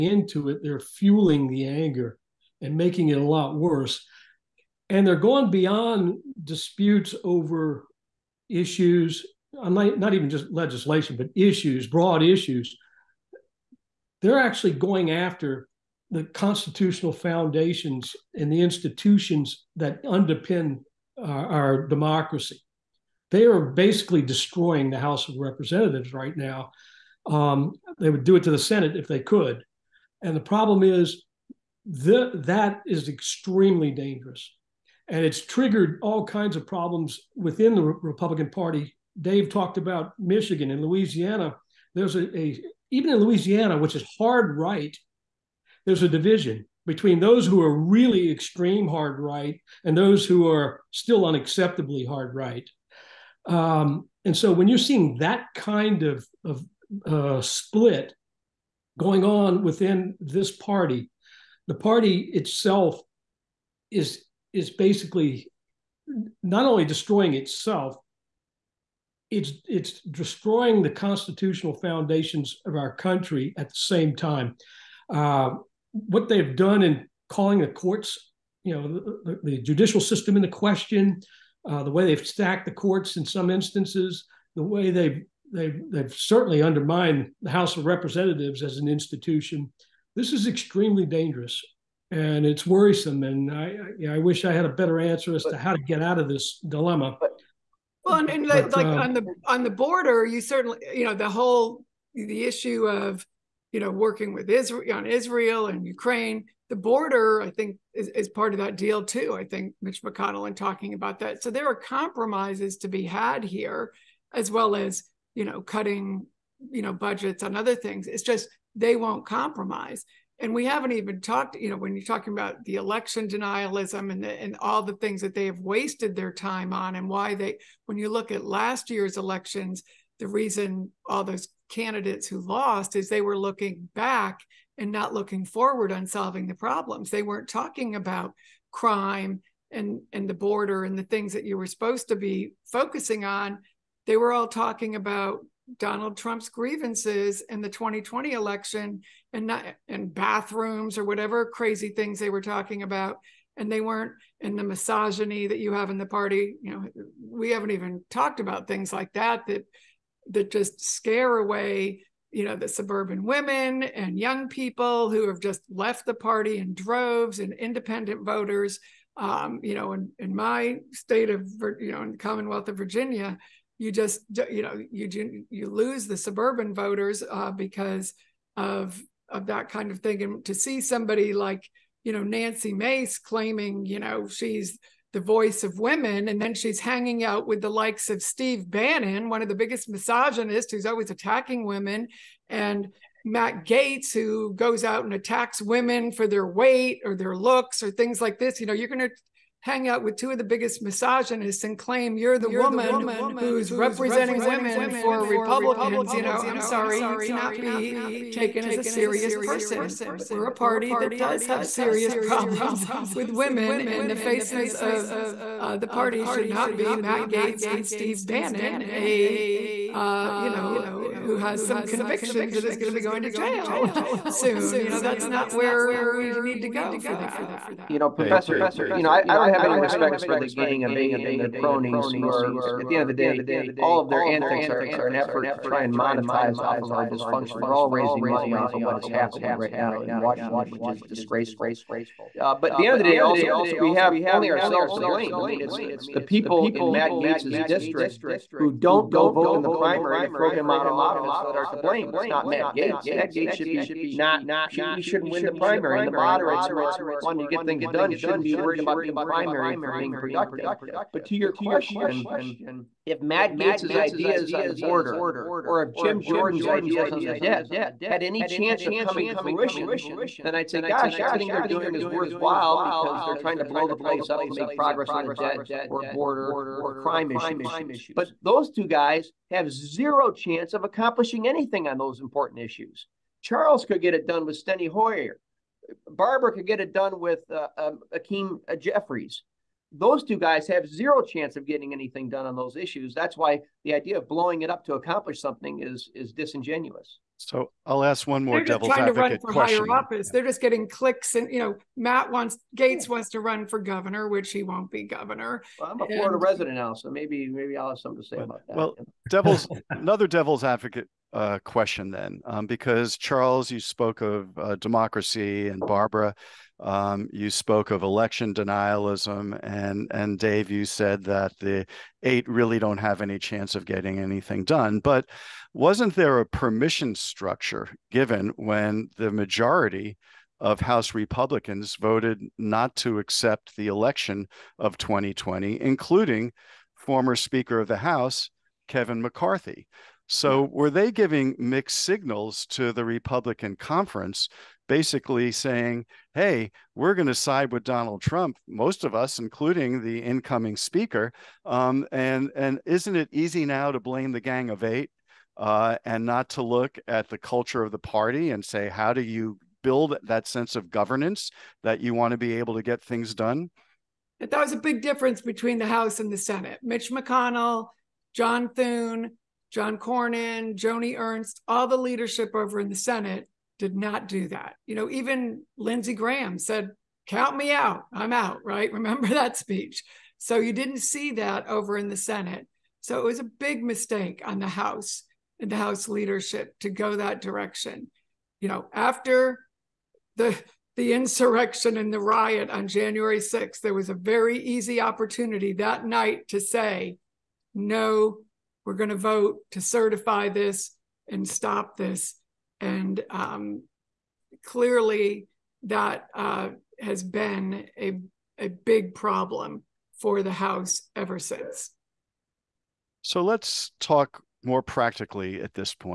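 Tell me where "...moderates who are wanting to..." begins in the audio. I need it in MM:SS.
04:16.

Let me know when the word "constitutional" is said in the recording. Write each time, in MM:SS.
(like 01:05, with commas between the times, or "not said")
00:16, 01:10.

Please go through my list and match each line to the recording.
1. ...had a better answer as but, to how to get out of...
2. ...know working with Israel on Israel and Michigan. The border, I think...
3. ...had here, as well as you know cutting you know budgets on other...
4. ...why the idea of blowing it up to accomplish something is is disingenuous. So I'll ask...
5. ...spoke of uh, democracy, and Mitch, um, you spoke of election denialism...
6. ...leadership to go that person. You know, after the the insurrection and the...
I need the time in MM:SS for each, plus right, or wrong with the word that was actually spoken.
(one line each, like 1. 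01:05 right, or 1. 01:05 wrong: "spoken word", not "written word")
1. 01:34 right
2. 01:43 wrong: "Ukraine", not "Michigan"
3. 01:53 right
4. 04:53 right
5. 05:13 wrong: "Barbara", not "Mitch"
6. 06:26 wrong: "direction", not "person".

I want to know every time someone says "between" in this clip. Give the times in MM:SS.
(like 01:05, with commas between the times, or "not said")
00:46, 06:05.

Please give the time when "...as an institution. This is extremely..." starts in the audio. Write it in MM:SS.
01:28.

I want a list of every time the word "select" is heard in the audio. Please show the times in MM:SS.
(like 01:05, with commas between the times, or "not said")
not said.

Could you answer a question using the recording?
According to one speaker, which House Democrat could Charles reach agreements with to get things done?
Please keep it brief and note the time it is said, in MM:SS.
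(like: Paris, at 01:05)
Steny Hoyer, at 04:44.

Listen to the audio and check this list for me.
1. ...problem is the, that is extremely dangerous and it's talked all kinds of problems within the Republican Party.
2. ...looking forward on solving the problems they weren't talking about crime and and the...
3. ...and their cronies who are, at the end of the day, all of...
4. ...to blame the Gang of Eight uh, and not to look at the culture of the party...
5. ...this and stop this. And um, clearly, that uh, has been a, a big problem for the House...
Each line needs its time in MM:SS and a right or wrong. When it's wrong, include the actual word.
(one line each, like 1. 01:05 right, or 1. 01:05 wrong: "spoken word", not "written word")
1. 00:30 wrong: "triggered", not "talked"
2. 02:15 right
3. 03:51 right
4. 05:53 right
5. 06:40 right.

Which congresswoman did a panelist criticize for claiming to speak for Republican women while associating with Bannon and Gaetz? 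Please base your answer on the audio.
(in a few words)
Nancy Mace.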